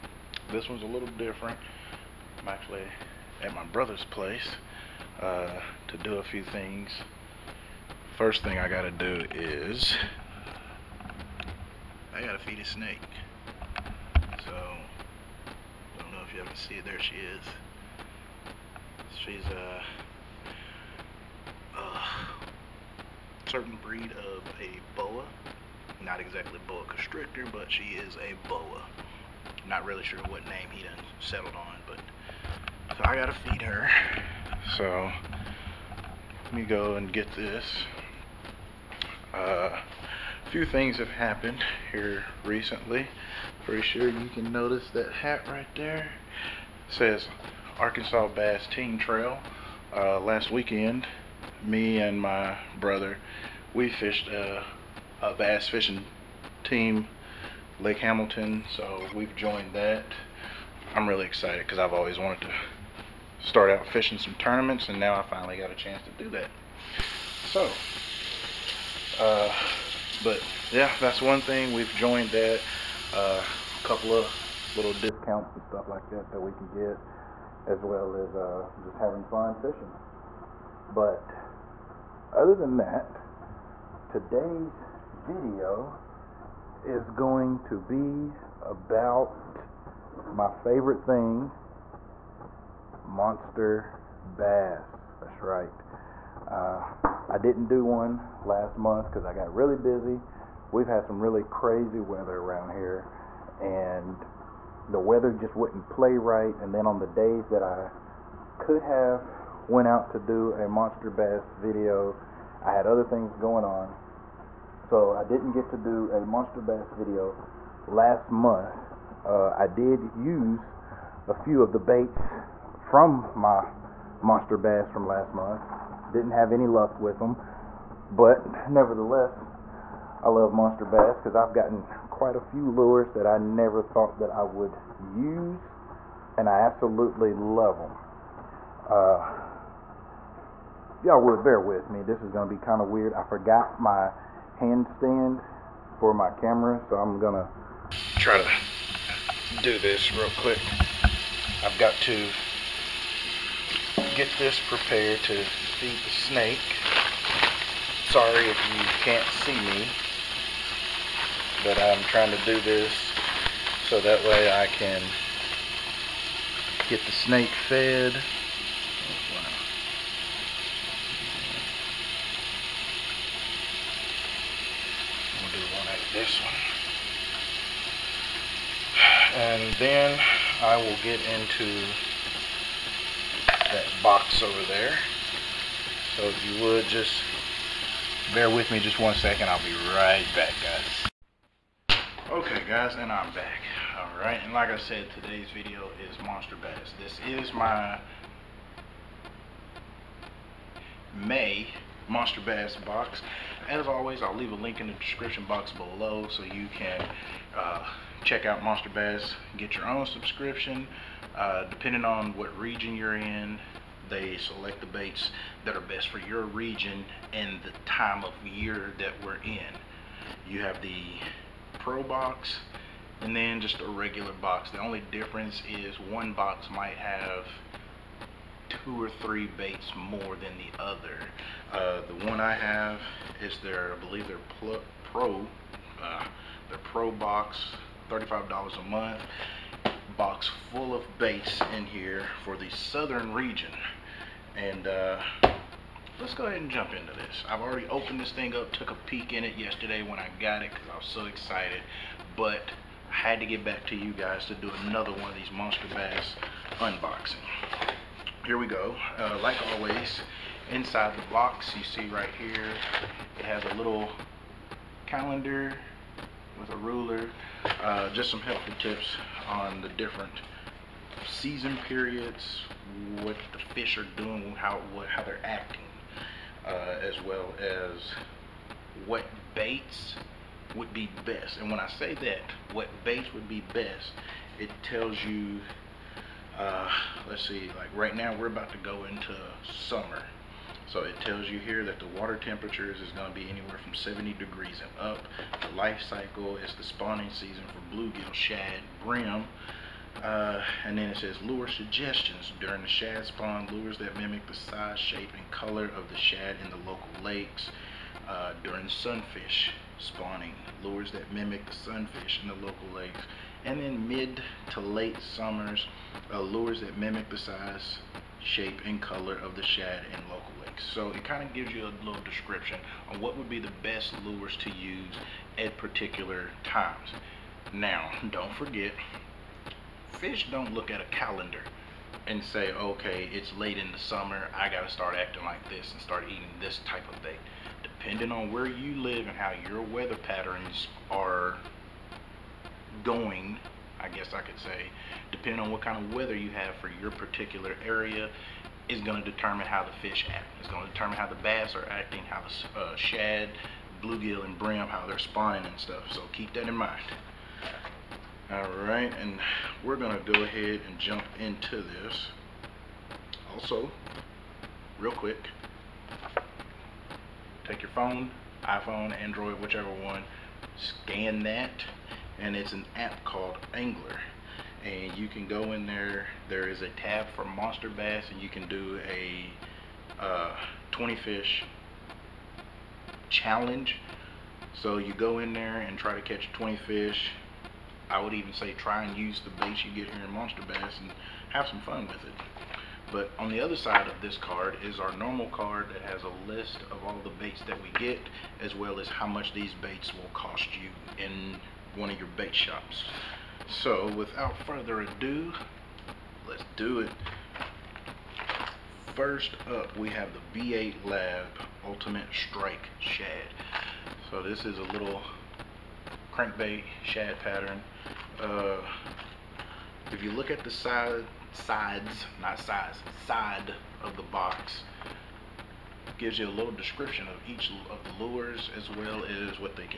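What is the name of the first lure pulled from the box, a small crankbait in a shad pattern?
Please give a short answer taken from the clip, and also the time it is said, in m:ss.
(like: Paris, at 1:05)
B8 Lab Ultimate Strike Shad, at 6:50.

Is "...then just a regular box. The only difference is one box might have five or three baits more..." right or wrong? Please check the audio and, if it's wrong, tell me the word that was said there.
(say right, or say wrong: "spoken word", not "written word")
wrong: "two", not "five".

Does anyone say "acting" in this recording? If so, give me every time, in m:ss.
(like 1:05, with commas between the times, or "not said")
4:35, 5:35, 5:51.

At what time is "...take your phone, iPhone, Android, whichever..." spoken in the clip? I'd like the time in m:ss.
6:07.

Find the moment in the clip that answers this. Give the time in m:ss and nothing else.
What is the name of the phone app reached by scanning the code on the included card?
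6:13.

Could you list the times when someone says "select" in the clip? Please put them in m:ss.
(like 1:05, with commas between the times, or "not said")
3:34.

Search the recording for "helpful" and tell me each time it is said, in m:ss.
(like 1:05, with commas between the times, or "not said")
4:28.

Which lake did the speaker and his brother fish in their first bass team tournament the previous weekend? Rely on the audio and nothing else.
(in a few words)
Lake Hamilton.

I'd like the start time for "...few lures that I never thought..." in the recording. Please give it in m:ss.
2:12.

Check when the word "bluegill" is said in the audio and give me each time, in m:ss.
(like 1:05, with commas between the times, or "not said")
4:57, 5:54.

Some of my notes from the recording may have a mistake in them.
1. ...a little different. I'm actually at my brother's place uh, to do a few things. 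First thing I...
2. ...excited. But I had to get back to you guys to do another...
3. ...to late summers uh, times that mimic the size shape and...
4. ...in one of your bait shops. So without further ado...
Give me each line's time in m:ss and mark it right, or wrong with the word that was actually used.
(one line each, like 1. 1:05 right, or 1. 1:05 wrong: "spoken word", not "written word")
1. 0:00 right
2. 4:11 right
3. 5:14 wrong: "lures", not "times"
4. 6:41 right.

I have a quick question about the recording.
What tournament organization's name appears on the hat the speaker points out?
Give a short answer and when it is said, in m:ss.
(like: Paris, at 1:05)
Arkansas Bass Team Trail, at 0:47.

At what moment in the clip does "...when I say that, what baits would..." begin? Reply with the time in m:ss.
4:41.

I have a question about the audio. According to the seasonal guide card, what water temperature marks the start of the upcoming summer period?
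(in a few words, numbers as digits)
70 degrees.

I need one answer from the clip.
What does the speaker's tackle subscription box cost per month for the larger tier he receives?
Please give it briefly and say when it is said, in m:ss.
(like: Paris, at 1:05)
$35, at 3:58.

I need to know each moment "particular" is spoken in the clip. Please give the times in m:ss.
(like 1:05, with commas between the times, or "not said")
5:25, 5:47.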